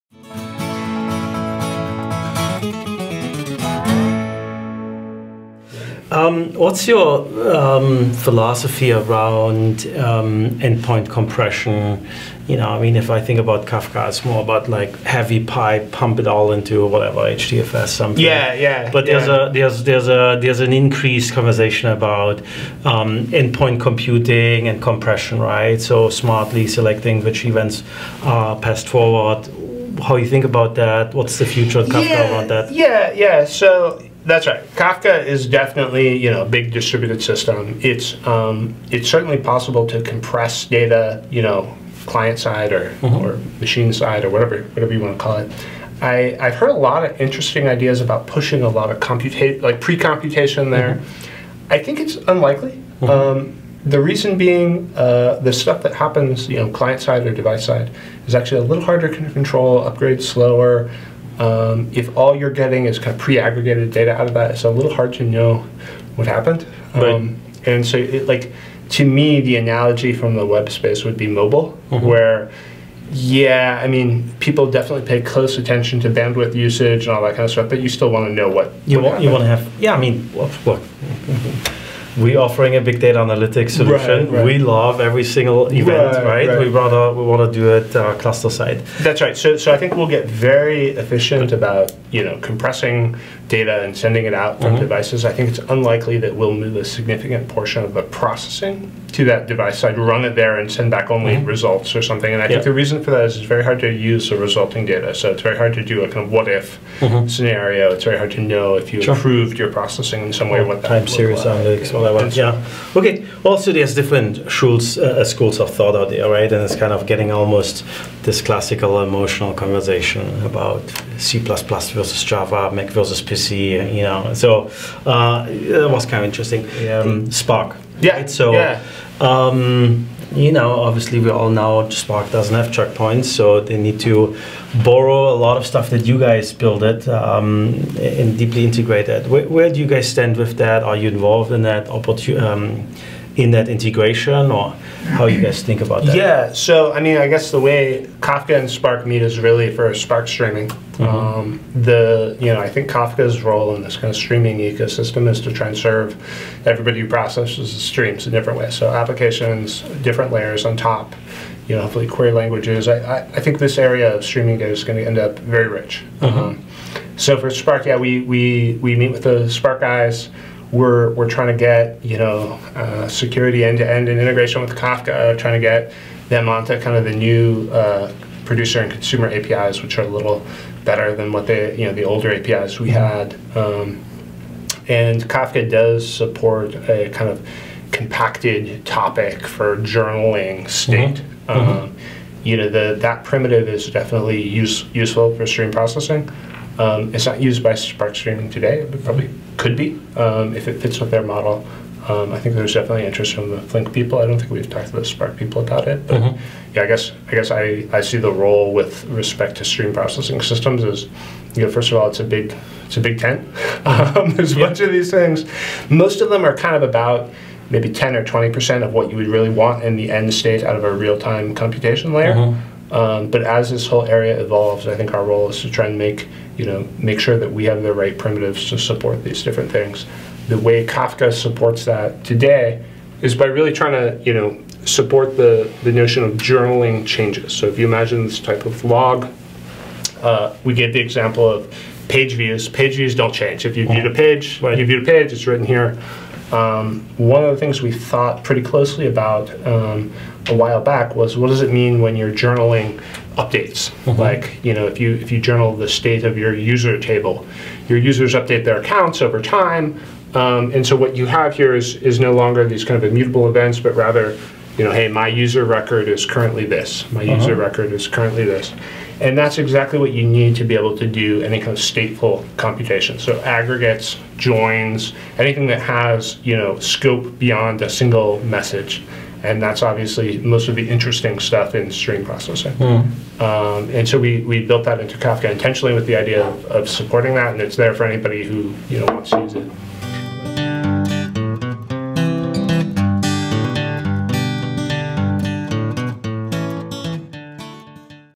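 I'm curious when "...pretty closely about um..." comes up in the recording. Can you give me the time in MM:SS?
04:08.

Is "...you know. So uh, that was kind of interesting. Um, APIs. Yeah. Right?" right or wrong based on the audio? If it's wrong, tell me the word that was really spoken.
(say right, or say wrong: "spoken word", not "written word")
wrong: "Spark", not "APIs".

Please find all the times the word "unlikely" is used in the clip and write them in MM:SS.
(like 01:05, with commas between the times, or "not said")
00:52, 01:35.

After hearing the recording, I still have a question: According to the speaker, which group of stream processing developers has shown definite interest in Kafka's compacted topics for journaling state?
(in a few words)
the Flink people.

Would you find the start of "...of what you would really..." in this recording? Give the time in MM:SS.
03:38.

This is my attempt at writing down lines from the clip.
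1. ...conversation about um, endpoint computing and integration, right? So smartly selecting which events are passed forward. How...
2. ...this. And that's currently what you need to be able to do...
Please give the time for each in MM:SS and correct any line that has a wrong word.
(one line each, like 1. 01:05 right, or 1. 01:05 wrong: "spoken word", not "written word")
1. 00:21 wrong: "compression", not "integration"
2. 04:28 wrong: "exactly", not "currently".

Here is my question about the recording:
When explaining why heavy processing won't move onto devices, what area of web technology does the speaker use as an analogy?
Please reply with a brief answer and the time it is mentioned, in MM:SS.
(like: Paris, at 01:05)
mobile, at 01:11.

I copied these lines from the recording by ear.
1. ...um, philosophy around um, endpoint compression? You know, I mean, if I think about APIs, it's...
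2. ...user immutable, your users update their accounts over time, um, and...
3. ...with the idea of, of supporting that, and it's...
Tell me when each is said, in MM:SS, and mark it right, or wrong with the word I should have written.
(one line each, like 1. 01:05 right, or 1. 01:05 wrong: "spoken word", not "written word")
1. 00:07 wrong: "Kafka", not "APIs"
2. 04:16 wrong: "table", not "immutable"
3. 04:45 right.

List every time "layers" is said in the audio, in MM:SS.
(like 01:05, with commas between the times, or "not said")
02:40, 03:42.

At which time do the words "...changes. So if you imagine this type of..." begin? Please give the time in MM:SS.
03:57.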